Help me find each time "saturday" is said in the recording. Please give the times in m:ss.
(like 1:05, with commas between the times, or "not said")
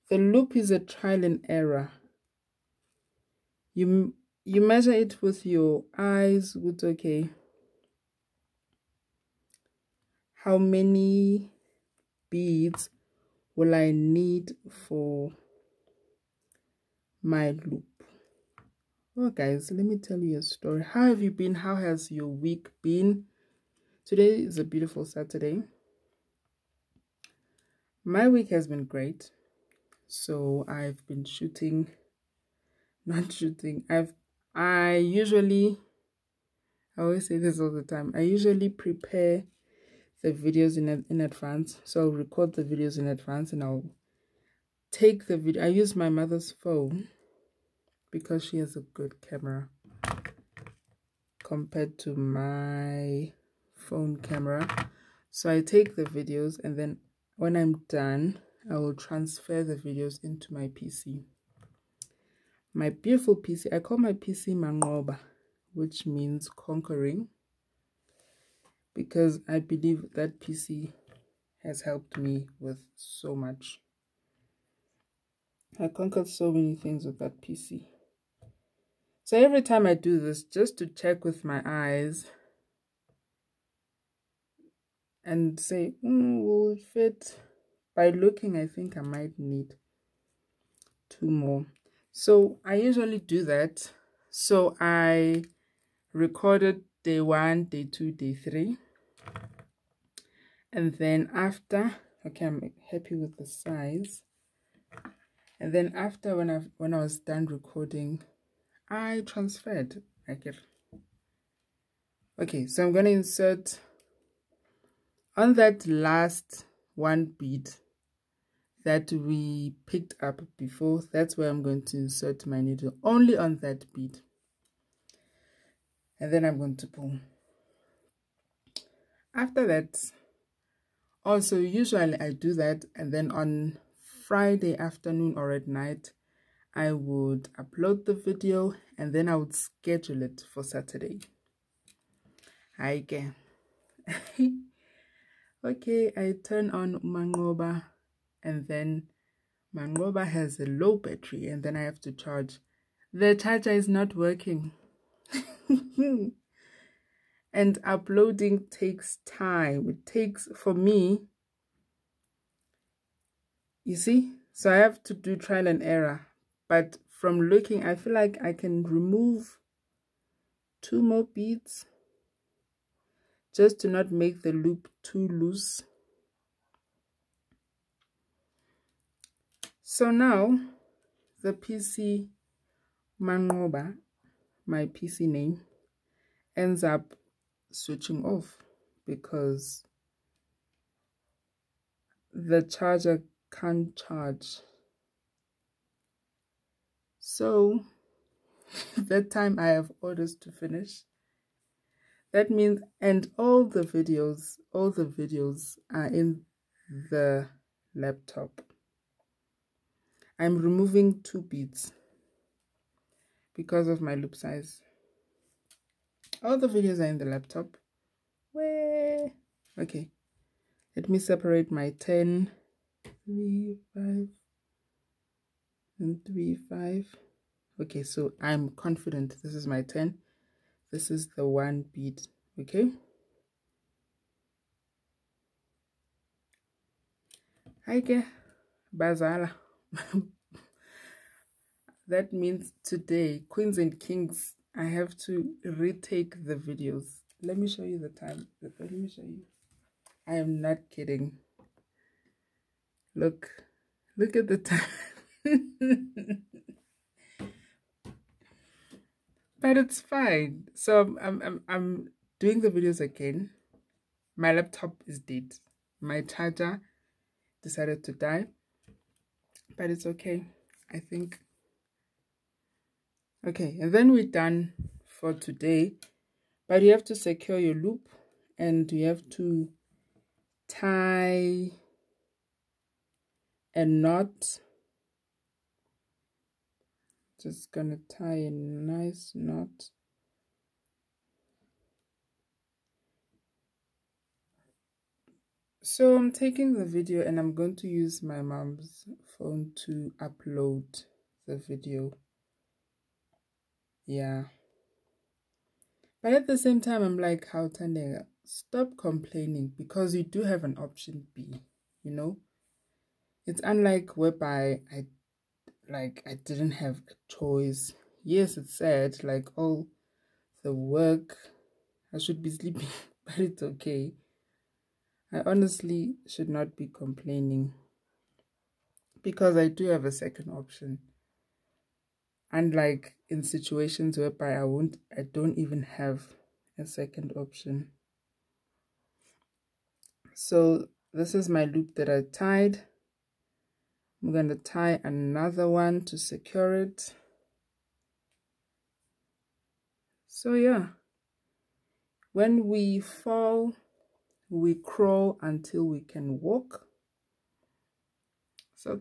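0:25, 2:20.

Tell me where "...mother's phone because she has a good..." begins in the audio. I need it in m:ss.
0:46.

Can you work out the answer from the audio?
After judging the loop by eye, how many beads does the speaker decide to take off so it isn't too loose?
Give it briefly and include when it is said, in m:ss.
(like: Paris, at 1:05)
2, at 2:50.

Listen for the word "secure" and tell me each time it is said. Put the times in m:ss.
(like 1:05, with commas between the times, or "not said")
4:37, 5:46.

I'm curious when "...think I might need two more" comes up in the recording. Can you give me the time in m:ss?
1:28.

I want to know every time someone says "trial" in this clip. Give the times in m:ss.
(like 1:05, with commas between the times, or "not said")
0:00, 2:45.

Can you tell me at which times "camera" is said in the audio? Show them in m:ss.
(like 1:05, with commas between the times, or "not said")
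0:49, 0:54.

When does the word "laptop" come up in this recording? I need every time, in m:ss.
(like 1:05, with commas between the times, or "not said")
3:27, 3:37, 4:24.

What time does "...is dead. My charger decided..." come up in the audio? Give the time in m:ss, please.
4:25.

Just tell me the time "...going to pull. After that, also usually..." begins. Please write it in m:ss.
2:06.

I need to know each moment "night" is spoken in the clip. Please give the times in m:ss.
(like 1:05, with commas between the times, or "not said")
2:15.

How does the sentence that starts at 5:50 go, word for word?
So yeah, when we fall, we crawl until we can walk.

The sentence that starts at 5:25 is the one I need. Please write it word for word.
I honestly should not be complaining because I do have a second option.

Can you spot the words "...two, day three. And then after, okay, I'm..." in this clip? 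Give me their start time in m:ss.
1:37.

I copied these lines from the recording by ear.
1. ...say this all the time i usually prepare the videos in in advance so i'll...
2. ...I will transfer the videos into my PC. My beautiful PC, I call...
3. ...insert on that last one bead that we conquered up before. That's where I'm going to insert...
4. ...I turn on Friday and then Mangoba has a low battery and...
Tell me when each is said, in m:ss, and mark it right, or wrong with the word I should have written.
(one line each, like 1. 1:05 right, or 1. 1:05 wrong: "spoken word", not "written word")
1. 0:37 right
2. 0:58 right
3. 1:53 wrong: "picked", not "conquered"
4. 2:26 wrong: "Mangoba", not "Friday".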